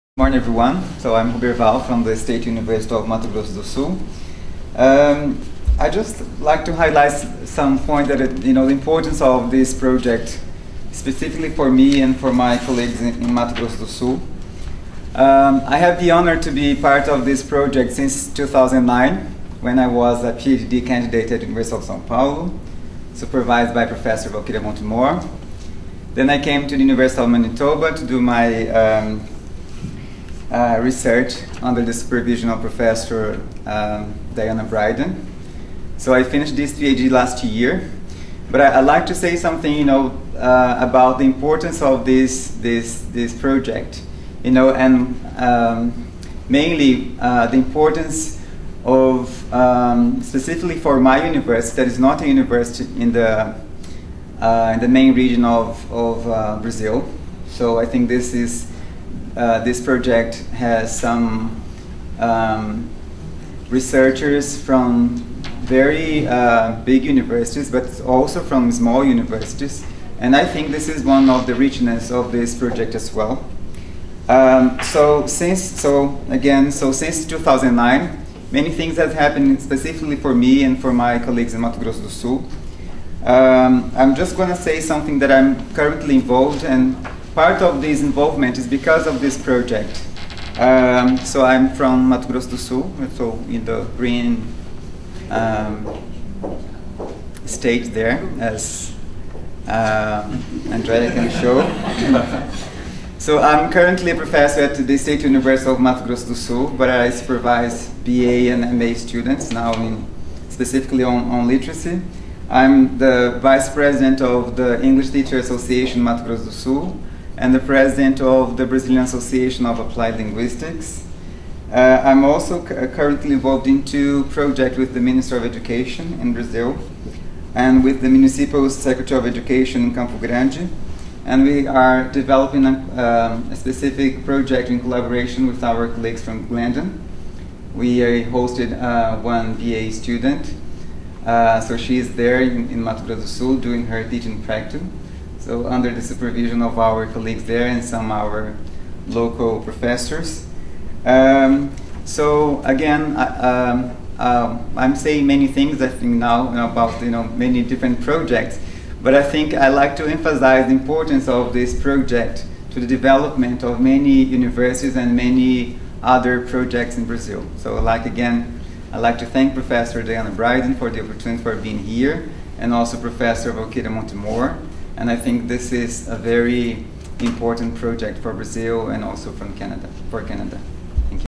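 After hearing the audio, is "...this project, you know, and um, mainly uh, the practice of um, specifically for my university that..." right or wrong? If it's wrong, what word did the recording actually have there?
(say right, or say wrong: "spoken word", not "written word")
wrong: "importance", not "practice".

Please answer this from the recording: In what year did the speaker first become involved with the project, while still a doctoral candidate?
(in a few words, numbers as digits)
2009.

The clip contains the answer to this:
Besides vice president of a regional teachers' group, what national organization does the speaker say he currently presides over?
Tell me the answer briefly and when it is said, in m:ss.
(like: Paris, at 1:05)
Brazilian Association of Applied Linguistics, at 1:58.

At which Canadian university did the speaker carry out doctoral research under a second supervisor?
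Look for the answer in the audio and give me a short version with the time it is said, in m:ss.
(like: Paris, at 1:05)
University of Manitoba, at 0:26.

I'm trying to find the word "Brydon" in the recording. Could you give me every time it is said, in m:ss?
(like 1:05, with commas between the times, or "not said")
0:34, 2:50.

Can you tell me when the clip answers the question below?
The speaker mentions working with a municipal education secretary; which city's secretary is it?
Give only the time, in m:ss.
2:09.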